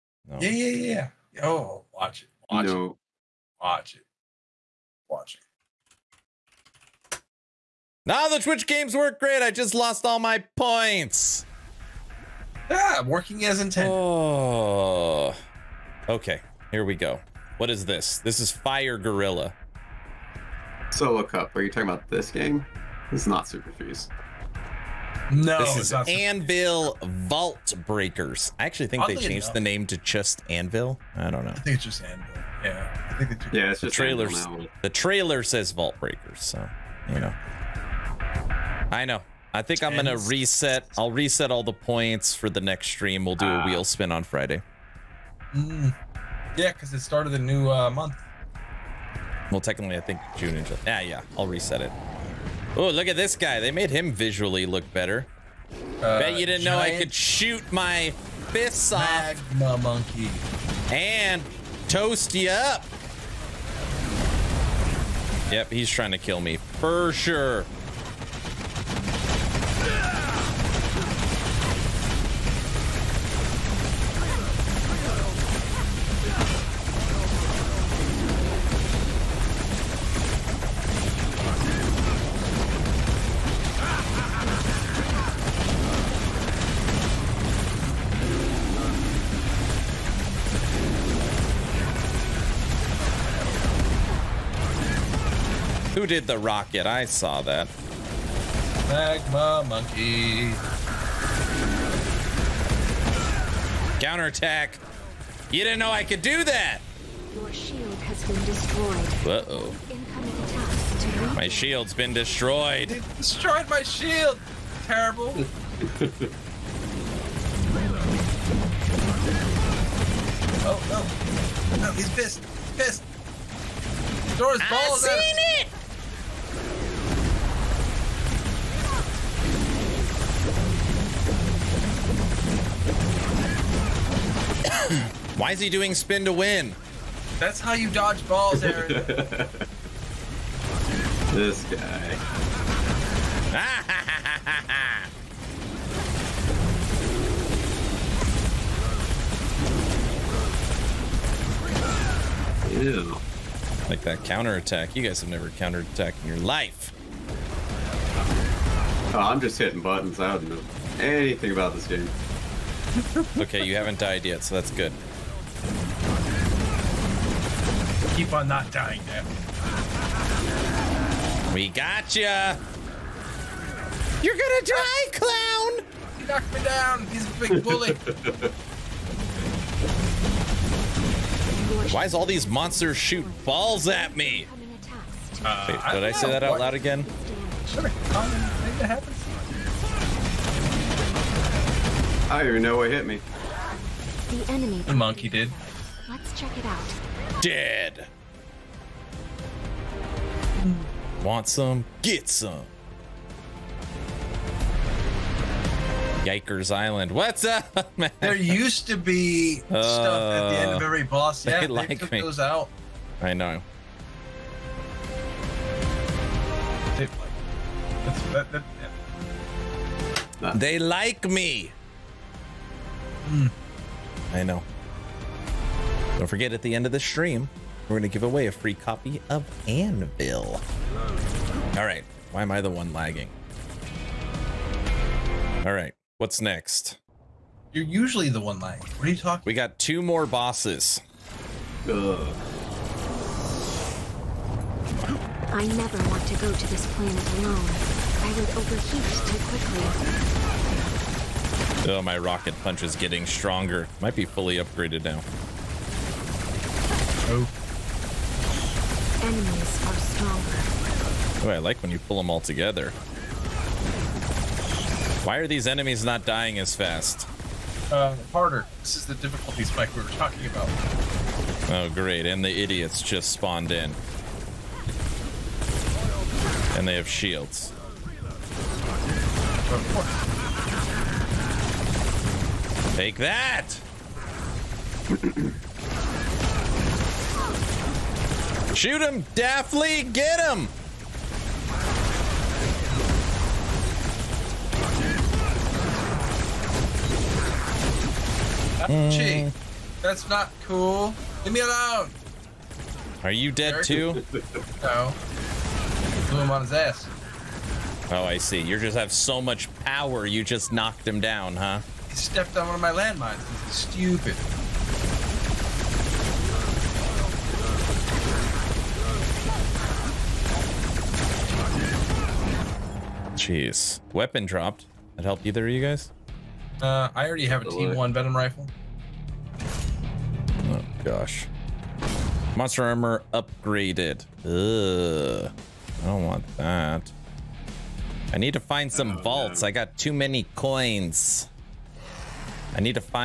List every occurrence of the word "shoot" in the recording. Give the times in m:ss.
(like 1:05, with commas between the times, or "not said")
0:57, 3:02, 4:48.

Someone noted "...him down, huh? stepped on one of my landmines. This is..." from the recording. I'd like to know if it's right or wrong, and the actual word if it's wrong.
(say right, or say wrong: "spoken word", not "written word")
right.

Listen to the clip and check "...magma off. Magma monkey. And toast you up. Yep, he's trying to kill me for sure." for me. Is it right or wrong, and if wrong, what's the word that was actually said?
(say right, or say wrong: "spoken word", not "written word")
right.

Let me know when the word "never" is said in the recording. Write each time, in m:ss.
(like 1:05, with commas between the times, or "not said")
2:35, 4:05.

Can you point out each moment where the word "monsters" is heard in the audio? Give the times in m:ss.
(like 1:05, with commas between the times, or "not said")
3:02, 5:32.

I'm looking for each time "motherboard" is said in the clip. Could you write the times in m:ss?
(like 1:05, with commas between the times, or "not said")
not said.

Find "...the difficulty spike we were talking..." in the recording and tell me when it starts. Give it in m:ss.
4:29.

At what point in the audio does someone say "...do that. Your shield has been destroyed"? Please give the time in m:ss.
1:46.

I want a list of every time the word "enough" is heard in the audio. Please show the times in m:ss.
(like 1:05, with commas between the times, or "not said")
0:29.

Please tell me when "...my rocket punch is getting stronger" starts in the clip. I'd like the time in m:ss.
4:12.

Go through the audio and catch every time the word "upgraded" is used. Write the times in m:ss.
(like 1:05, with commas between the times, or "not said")
4:14, 5:33.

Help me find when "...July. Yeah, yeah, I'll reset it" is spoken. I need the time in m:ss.
0:50.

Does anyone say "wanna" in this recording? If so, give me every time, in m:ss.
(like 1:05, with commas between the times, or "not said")
not said.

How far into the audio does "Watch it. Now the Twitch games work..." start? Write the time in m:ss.
0:05.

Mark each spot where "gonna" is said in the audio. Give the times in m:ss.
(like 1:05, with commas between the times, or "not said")
0:39, 2:54.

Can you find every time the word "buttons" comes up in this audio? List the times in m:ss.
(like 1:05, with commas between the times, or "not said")
2:39.